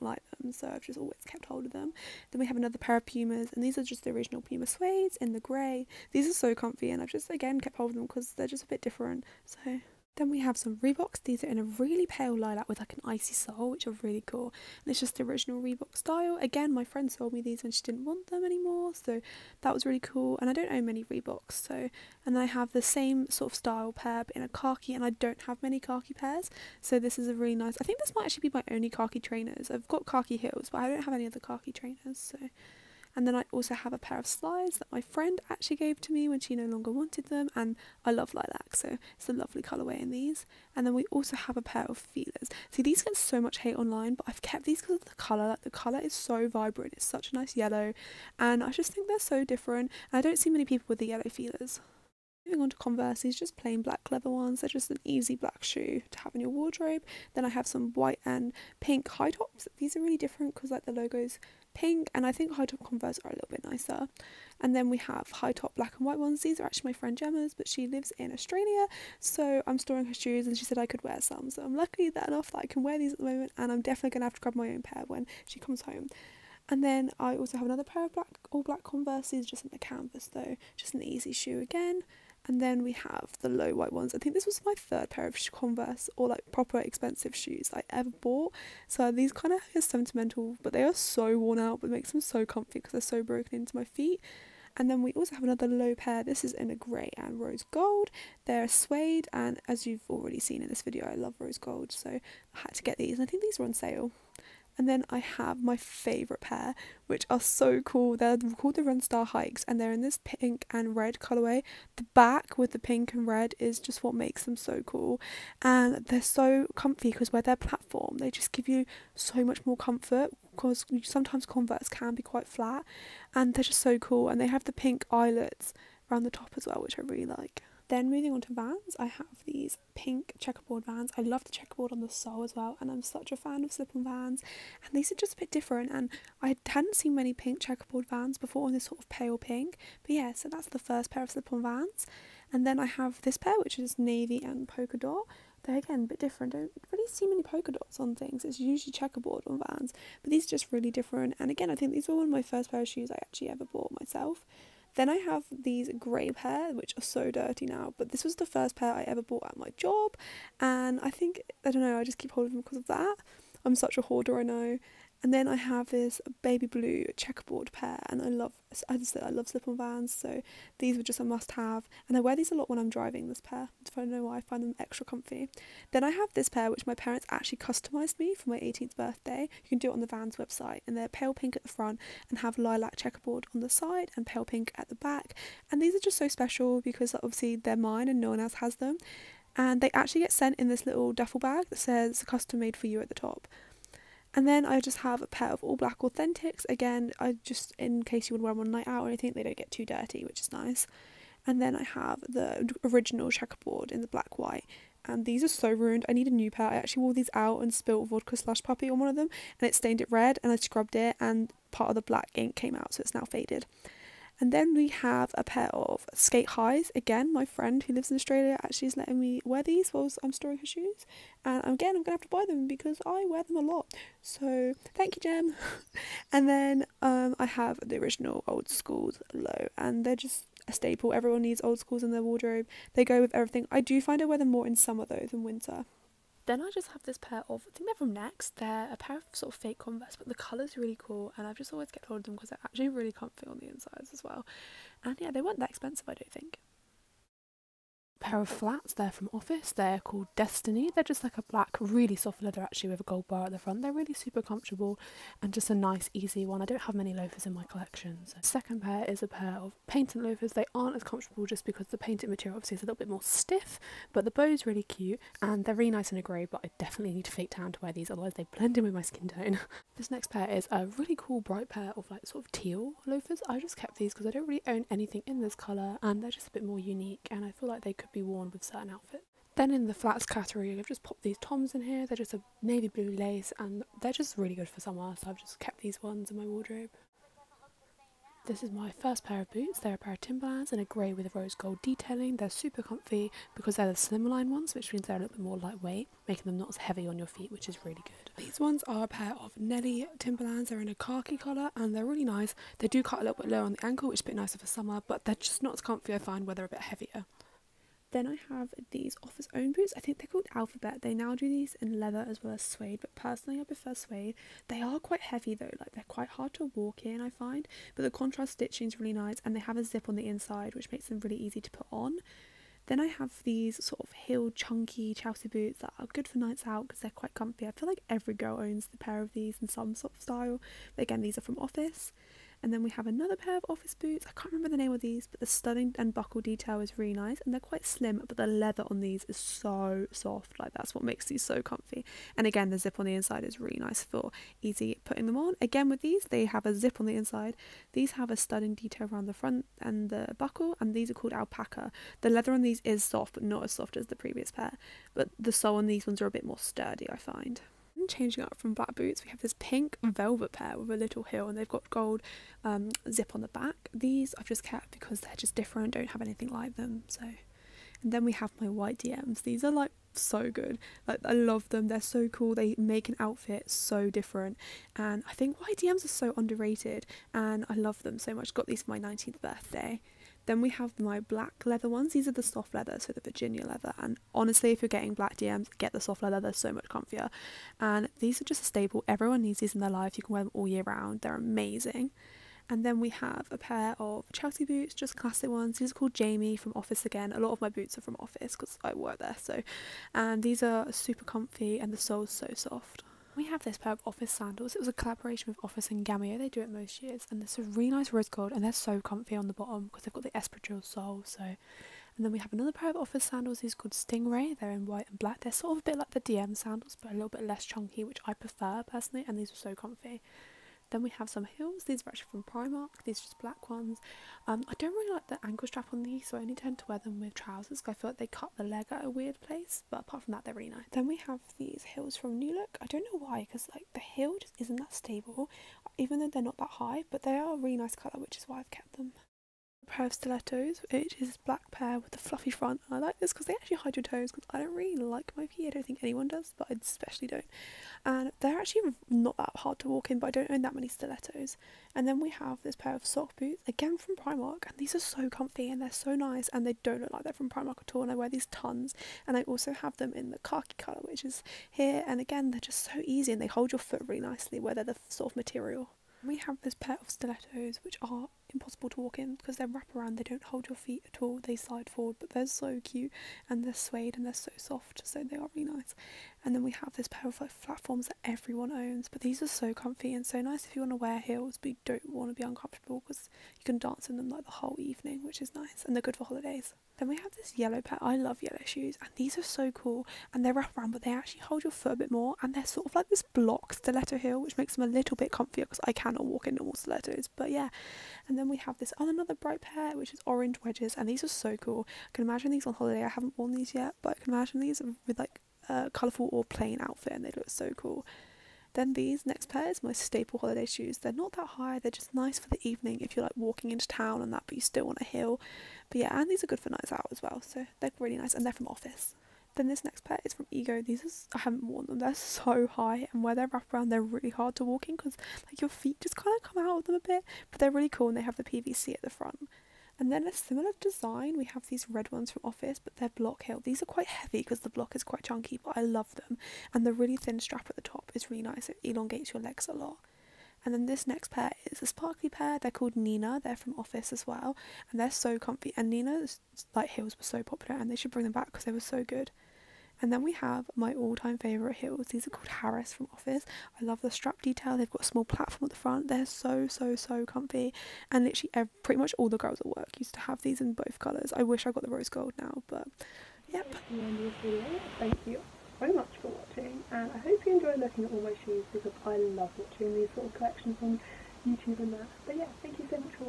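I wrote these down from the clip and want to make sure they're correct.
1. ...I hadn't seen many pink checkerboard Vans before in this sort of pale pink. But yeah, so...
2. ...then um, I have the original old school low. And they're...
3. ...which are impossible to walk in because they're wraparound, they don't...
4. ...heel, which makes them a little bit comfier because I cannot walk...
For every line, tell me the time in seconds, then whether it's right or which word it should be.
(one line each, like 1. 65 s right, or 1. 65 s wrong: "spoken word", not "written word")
1. 136 s right
2. 226 s right
3. 467 s right
4. 494 s right.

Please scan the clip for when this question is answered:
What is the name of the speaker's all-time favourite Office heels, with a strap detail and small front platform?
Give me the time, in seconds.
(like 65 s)
552 s.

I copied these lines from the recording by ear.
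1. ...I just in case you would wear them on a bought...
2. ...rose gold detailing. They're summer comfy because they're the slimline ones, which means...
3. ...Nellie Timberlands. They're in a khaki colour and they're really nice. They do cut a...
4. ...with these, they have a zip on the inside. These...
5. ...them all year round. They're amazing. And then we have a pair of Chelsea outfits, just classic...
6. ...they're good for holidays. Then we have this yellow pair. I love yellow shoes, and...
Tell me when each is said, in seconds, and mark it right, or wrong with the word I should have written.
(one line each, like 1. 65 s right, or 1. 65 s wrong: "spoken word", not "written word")
1. 197 s wrong: "night", not "bought"
2. 291 s wrong: "super", not "summer"
3. 299 s right
4. 345 s right
5. 390 s wrong: "boots", not "outfits"
6. 485 s right.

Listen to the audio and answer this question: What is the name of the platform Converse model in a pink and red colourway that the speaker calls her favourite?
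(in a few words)
Runstar Hikes.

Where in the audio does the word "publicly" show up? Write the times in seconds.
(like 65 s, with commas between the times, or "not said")
not said.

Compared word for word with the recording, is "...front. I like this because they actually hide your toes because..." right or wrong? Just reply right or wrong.
right.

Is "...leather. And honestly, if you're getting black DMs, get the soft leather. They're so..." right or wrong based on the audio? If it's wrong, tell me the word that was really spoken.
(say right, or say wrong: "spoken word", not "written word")
right.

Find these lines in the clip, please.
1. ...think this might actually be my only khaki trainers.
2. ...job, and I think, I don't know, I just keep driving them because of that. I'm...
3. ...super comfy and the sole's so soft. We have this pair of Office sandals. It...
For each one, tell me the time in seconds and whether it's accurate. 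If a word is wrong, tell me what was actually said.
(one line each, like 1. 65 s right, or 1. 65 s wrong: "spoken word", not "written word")
1. 27 s right
2. 159 s wrong: "holding", not "driving"
3. 400 s right.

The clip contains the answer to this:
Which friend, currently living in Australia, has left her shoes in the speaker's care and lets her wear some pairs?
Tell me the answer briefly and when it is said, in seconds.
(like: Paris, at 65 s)
Gemma, at 67 s.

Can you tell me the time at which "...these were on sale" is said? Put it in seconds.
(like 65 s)
103 s.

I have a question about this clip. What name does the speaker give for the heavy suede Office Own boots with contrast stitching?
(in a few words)
Alphabet.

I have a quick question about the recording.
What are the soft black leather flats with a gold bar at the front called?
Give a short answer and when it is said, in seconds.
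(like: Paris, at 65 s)
Destiny, at 250 s.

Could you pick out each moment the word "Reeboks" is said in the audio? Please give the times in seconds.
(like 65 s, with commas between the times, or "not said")
10 s, 15 s, 21 s.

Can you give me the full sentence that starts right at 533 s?
These are quite heavy because the block is quite chunky, but I love them.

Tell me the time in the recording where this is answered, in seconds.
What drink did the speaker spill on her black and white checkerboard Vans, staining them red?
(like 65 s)
208 s.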